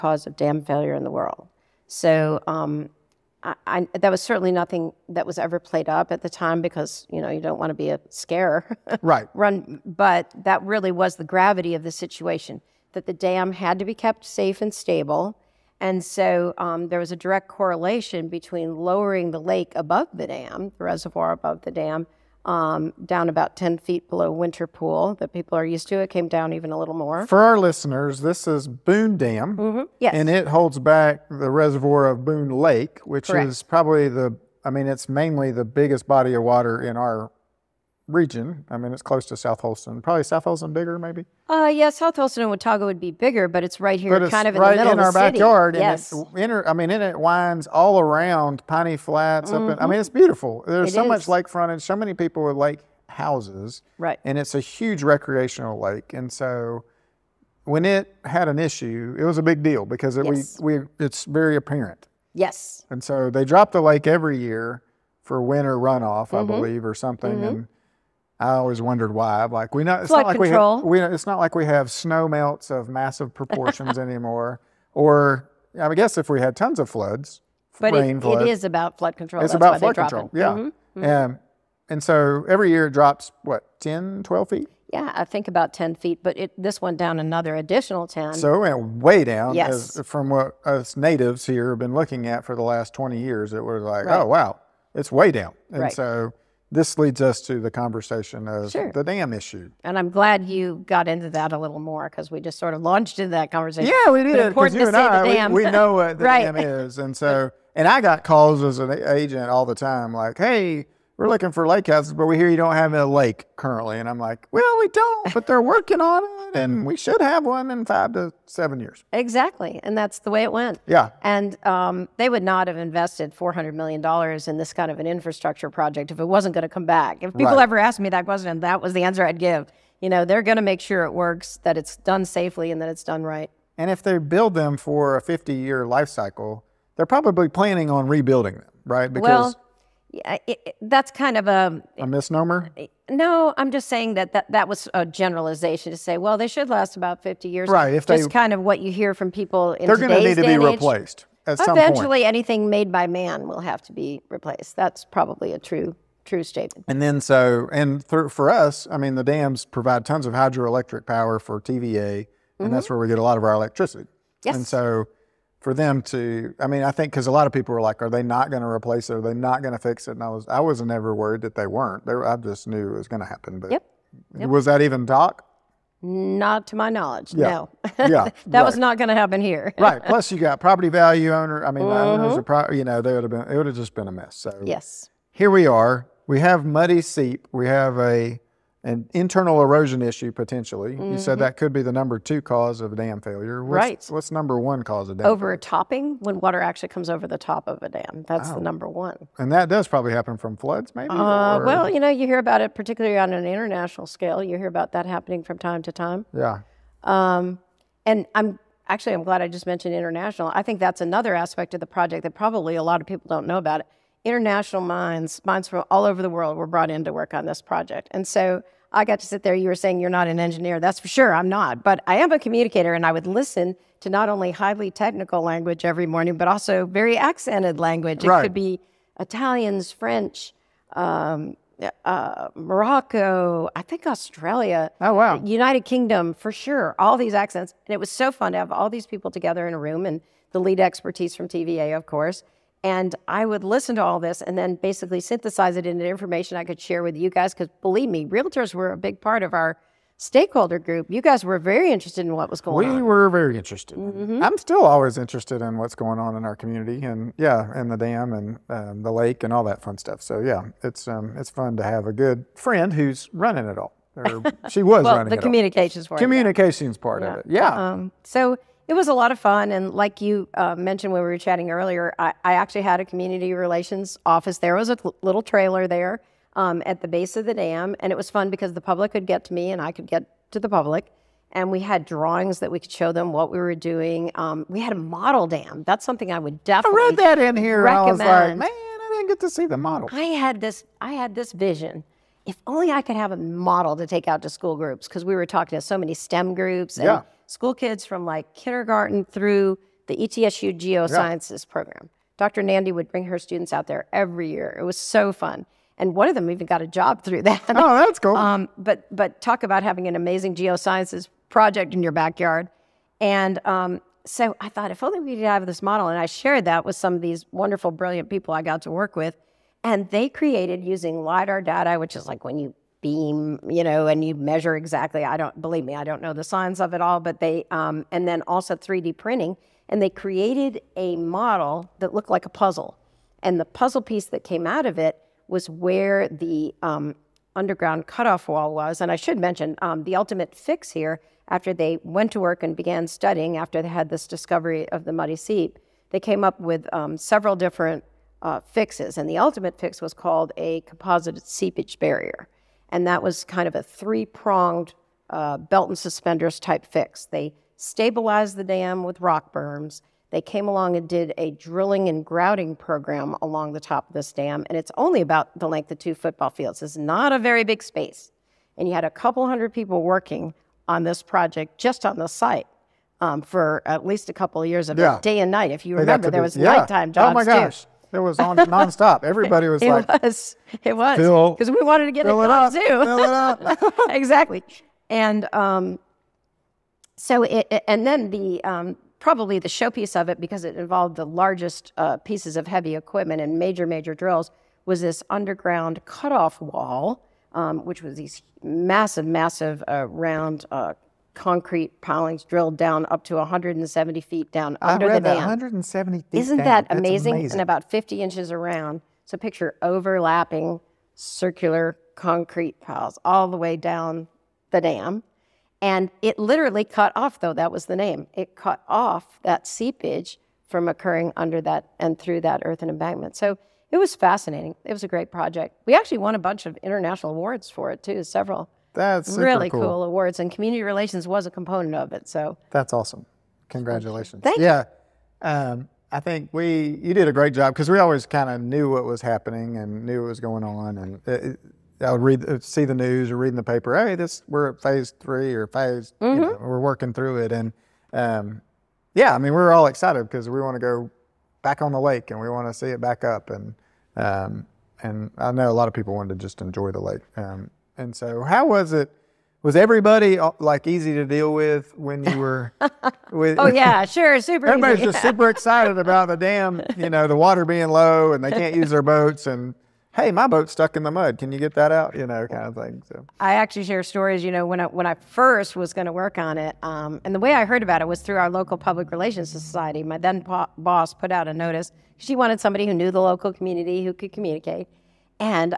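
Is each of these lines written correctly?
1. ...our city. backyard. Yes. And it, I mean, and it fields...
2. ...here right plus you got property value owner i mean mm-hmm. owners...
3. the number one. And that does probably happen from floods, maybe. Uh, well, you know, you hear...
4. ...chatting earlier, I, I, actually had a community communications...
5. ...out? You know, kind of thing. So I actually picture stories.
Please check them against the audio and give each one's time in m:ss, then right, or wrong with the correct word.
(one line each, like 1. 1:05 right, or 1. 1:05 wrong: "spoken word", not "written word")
1. 0:45 wrong: "winds", not "fields"
2. 2:59 right
3. 3:18 right
4. 4:31 wrong: "relations", not "communications"
5. 7:51 wrong: "share", not "picture".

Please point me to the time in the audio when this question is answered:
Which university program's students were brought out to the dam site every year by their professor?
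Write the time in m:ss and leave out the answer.
5:00.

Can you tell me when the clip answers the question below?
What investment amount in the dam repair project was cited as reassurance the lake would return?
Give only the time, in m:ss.
2:03.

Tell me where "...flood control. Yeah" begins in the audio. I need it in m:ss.
1:19.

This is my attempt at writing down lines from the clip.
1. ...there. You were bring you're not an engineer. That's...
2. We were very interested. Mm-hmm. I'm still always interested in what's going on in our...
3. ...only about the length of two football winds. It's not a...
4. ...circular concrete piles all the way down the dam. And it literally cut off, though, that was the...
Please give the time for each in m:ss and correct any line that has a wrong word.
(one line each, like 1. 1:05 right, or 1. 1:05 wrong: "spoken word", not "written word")
1. 3:39 wrong: "saying", not "bring"
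2. 4:12 right
3. 6:04 wrong: "fields", not "winds"
4. 6:51 right.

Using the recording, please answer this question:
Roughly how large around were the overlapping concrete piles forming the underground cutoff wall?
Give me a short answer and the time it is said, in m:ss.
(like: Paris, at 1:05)
50 inches, at 6:47.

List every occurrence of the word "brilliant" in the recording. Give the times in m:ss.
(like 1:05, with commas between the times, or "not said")
5:17.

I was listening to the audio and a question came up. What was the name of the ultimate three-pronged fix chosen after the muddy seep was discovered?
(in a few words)
Composite seepage barrier.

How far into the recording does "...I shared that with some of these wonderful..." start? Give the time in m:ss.
5:16.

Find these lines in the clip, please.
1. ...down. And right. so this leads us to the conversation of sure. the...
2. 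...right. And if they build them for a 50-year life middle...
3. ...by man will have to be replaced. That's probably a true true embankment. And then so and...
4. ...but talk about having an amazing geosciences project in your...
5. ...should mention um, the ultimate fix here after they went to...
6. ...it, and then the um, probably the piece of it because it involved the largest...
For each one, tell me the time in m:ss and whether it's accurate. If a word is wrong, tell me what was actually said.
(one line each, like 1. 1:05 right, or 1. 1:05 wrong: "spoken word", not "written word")
1. 1:35 right
2. 2:13 wrong: "cycle", not "middle"
3. 2:32 wrong: "statement", not "embankment"
4. 5:09 right
5. 5:39 right
6. 6:27 wrong: "showpiece", not "piece".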